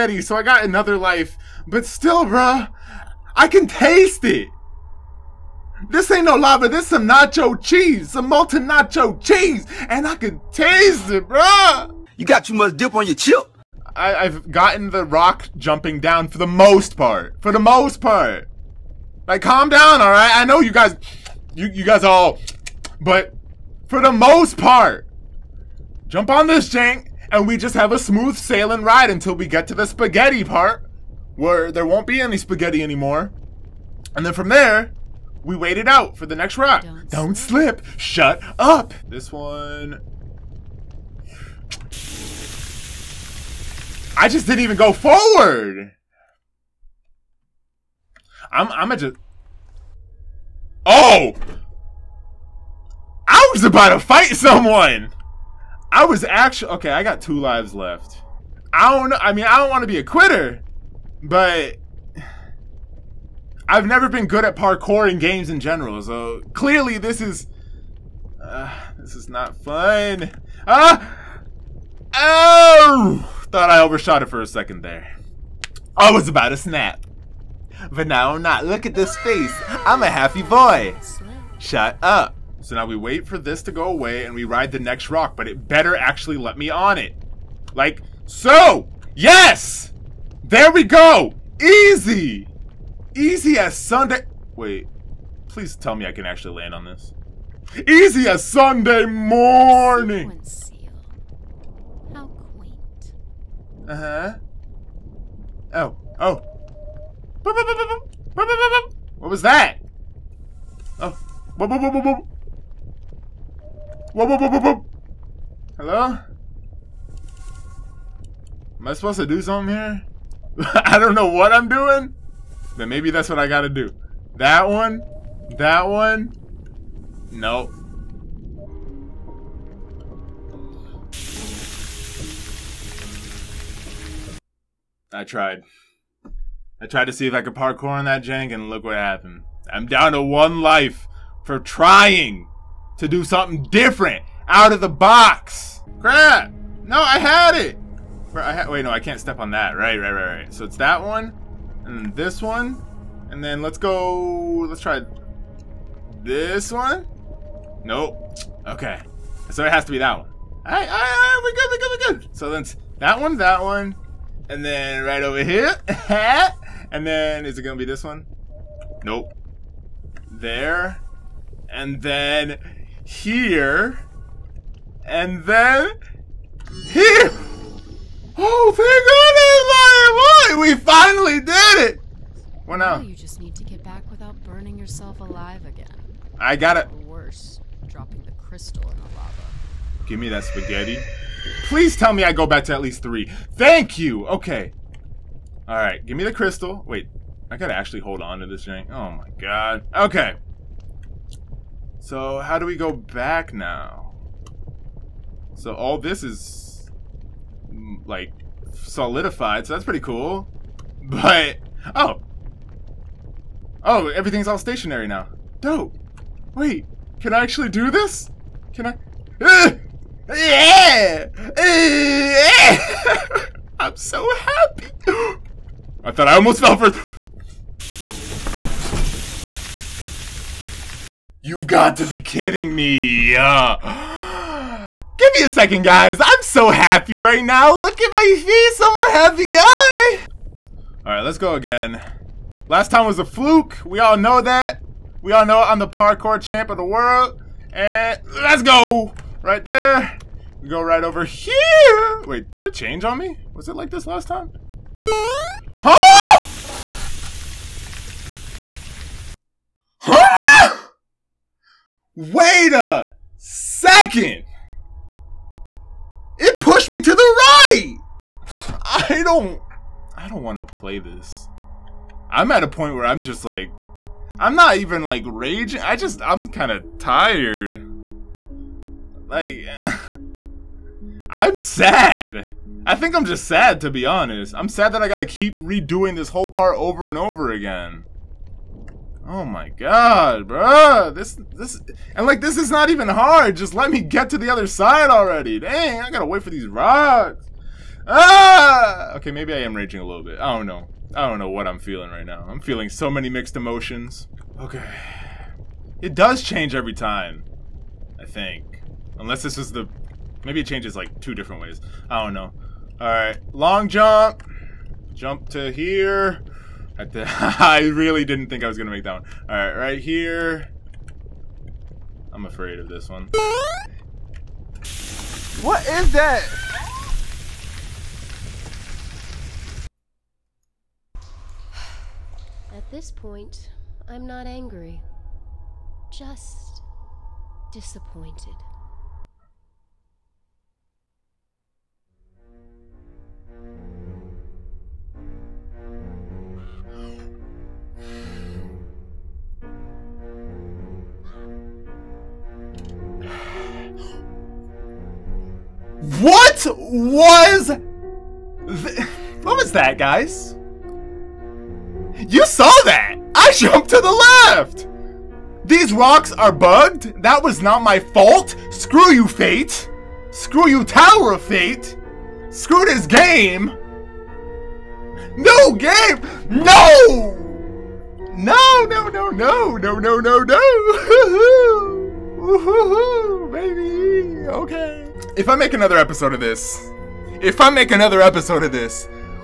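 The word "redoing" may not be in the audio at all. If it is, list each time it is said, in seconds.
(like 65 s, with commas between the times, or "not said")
285 s.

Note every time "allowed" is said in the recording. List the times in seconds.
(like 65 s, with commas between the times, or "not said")
not said.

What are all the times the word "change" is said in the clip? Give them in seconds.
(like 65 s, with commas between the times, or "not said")
252 s, 306 s, 310 s.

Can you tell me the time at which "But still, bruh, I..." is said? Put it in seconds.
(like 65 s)
1 s.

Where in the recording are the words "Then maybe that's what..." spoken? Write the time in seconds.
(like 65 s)
122 s.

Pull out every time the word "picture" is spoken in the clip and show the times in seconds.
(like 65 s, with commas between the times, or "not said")
not said.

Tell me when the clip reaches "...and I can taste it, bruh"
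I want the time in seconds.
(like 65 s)
9 s.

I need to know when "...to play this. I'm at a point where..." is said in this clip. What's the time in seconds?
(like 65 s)
270 s.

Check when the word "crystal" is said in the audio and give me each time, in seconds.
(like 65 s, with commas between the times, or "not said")
188 s, 196 s.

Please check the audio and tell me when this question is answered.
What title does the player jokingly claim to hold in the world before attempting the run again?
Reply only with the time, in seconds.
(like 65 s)
245 s.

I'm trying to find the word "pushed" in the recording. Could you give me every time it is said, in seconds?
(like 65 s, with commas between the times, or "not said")
266 s.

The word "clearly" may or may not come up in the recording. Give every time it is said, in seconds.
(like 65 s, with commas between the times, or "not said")
66 s.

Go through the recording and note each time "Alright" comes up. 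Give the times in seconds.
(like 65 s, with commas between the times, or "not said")
312 s, 319 s.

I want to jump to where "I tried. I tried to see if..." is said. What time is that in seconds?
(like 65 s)
135 s.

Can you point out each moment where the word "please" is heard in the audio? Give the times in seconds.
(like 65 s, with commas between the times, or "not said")
95 s, 191 s.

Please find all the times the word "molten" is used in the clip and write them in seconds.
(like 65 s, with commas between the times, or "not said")
8 s.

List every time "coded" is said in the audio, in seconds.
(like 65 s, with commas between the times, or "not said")
not said.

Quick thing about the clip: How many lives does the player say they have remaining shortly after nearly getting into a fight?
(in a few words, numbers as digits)
2.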